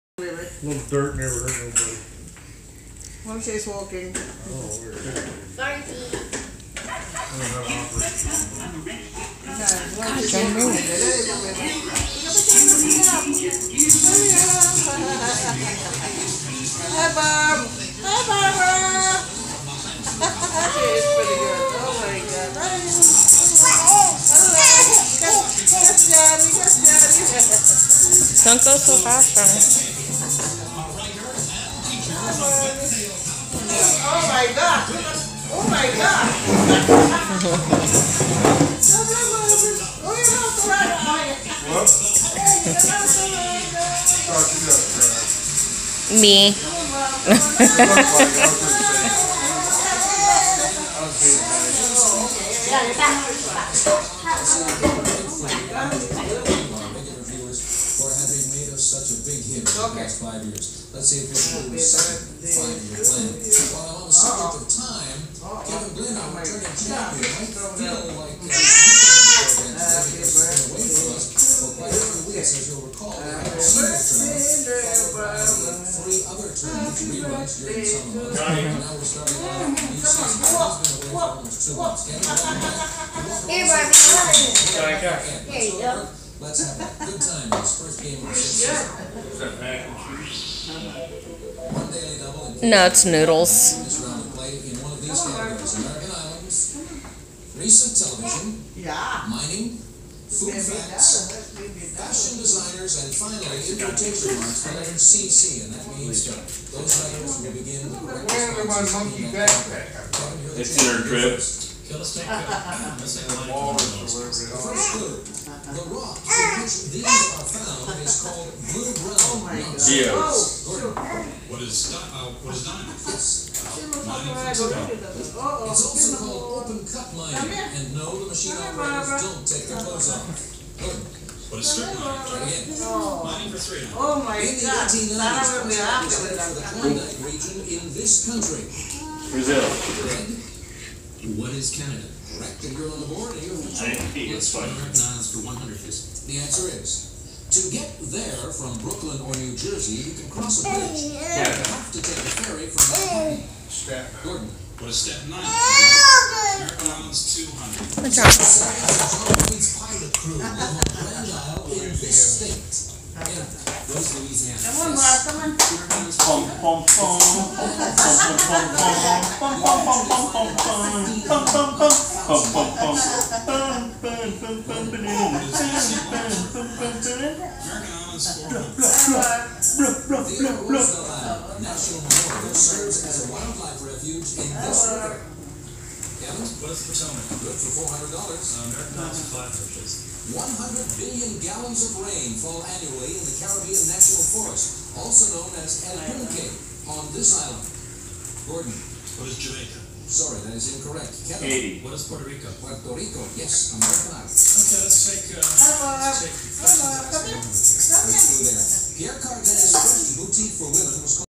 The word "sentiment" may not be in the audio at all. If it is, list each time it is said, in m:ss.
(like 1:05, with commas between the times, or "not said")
not said.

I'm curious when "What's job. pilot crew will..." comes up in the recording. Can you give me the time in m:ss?
2:38.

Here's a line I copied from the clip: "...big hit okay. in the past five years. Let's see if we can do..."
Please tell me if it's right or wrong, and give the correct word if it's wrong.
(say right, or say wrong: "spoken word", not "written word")
right.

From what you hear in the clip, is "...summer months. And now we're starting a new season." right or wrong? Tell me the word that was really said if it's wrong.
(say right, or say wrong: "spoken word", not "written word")
right.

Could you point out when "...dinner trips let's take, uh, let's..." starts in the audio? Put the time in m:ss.
1:50.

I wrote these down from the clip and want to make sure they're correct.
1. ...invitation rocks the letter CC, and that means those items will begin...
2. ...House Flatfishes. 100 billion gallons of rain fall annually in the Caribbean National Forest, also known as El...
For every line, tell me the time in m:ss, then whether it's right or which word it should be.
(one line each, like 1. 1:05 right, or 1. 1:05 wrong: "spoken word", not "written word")
1. 1:43 wrong: "marks", not "rocks"
2. 3:08 right.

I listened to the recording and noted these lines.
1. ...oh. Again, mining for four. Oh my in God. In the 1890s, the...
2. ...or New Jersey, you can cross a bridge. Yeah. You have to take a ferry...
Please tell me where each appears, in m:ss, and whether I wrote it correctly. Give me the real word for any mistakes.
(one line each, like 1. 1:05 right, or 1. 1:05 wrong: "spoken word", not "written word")
1. 2:11 wrong: "three", not "four"
2. 2:29 right.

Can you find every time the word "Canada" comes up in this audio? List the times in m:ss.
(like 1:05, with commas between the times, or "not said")
2:21, 3:21.